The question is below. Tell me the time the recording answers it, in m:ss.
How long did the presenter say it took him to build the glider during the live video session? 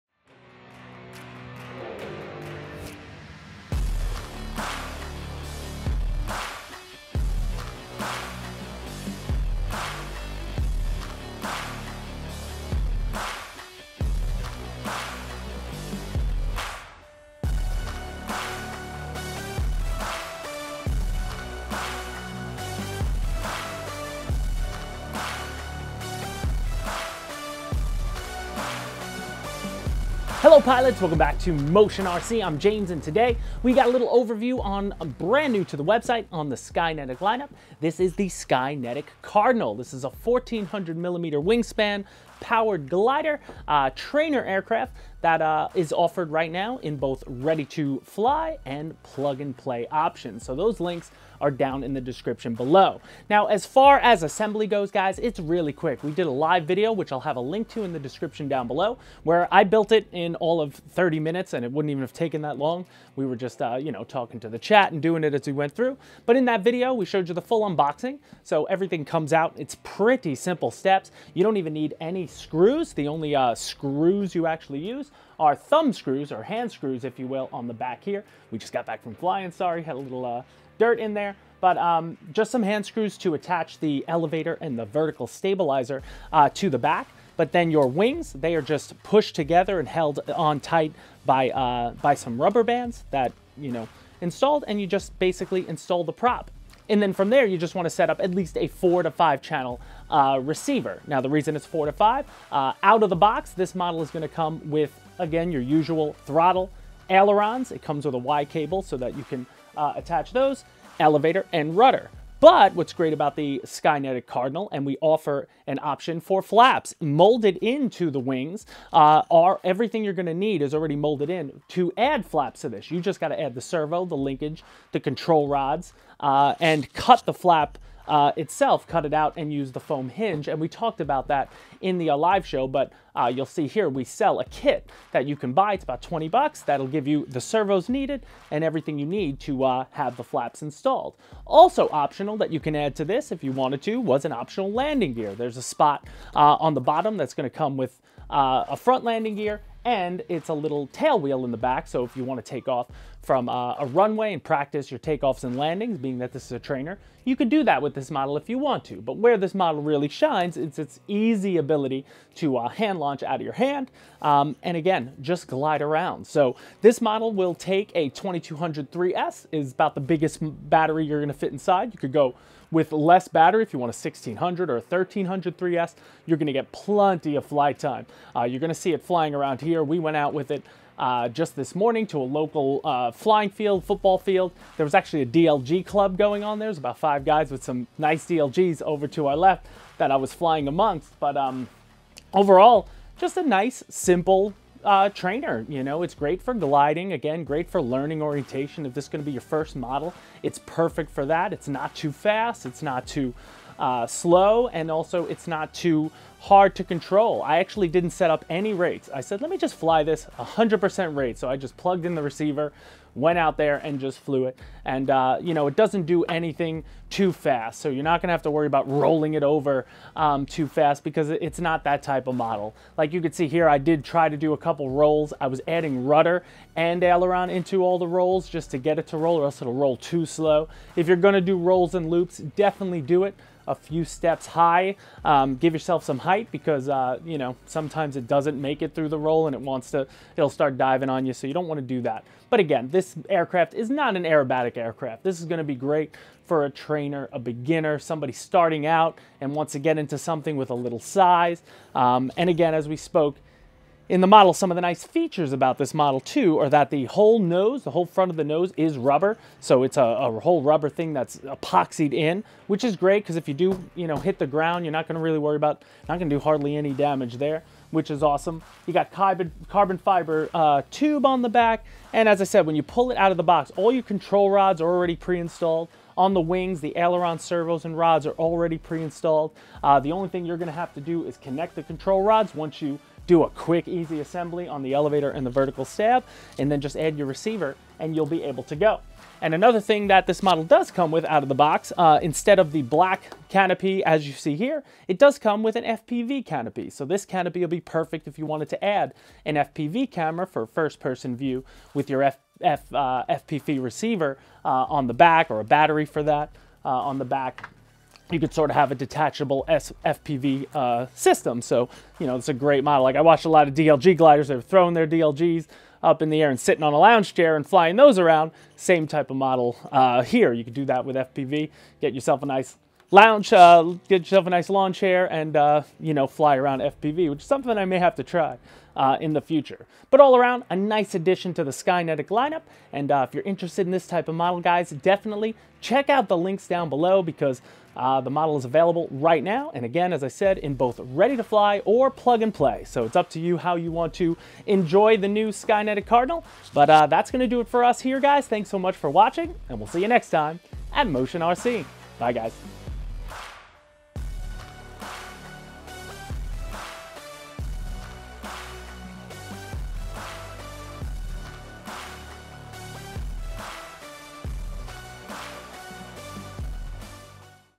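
1:00.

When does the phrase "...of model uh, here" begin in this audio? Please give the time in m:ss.
5:19.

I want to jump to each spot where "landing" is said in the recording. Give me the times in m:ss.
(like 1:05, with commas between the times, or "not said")
2:24, 2:29, 2:35.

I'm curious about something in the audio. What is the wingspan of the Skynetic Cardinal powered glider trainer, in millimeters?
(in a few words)
1400 millimeters.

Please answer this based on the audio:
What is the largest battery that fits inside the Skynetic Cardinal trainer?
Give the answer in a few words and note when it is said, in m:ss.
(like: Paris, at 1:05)
2200 3S, at 2:48.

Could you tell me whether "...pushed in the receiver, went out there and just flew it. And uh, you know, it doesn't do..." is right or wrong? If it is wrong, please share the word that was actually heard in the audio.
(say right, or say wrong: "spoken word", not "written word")
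wrong: "plugged", not "pushed".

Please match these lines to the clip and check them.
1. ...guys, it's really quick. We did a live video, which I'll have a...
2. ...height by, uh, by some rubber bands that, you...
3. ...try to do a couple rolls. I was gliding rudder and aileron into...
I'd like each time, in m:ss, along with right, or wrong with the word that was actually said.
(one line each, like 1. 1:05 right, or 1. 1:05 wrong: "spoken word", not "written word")
1. 0:54 right
2. 1:30 wrong: "tight", not "height"
3. 3:44 wrong: "adding", not "gliding".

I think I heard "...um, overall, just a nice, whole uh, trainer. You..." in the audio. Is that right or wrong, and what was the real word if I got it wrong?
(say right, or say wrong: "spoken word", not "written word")
wrong: "simple", not "whole".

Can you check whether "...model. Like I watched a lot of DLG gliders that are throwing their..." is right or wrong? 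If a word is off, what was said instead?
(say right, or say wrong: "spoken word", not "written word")
right.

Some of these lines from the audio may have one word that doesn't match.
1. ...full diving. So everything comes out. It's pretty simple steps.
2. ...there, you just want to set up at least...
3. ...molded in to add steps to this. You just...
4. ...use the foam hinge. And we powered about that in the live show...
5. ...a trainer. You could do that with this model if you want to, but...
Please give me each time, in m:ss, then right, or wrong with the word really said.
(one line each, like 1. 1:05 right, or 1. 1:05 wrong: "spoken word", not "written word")
1. 1:07 wrong: "unboxing", not "diving"
2. 1:37 right
3. 2:00 wrong: "flaps", not "steps"
4. 2:09 wrong: "talked", not "powered"
5. 2:36 right.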